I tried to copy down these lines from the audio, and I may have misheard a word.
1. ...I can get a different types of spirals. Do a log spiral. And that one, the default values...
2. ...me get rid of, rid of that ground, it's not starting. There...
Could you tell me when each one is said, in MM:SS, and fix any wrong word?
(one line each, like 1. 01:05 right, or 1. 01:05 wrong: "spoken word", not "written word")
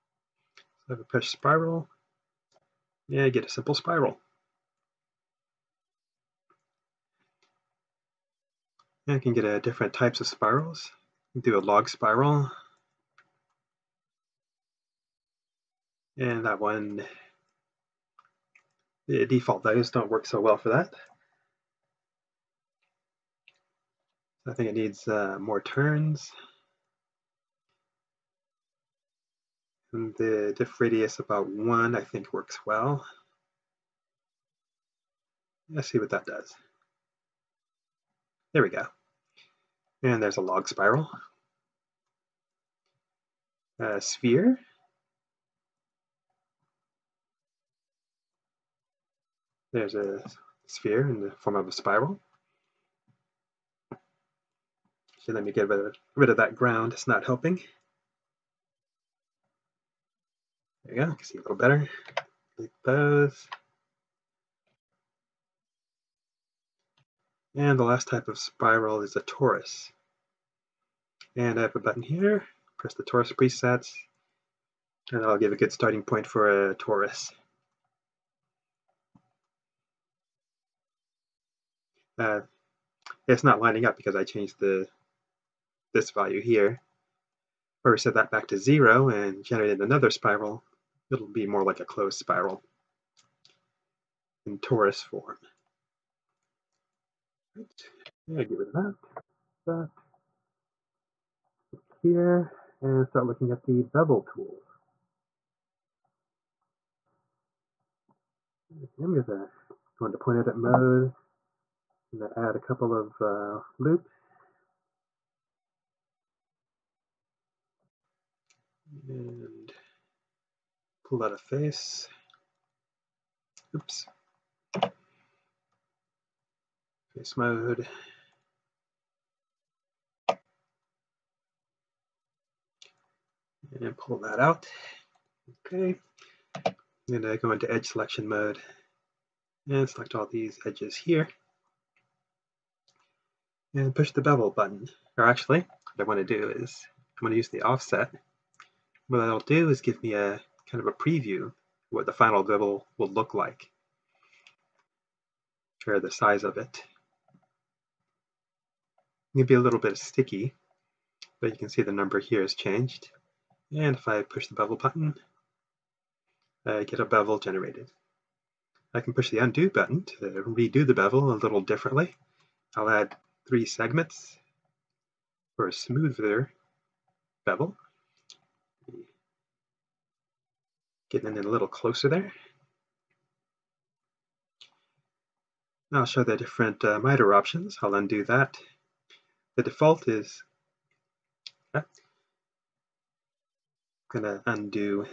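1. 00:09 right
2. 00:55 wrong: "helping", not "starting".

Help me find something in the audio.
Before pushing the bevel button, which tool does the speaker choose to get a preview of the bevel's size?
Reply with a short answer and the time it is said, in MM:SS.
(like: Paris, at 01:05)
Offset, at 02:27.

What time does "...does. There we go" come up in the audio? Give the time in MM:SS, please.
00:36.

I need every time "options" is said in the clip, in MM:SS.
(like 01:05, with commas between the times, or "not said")
03:07.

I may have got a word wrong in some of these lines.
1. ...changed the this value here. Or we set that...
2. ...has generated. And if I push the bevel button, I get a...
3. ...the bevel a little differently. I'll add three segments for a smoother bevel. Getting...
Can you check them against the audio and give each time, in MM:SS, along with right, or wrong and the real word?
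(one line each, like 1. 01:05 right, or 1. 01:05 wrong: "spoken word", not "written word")
1. 01:24 right
2. 02:42 wrong: "changed", not "generated"
3. 02:50 right.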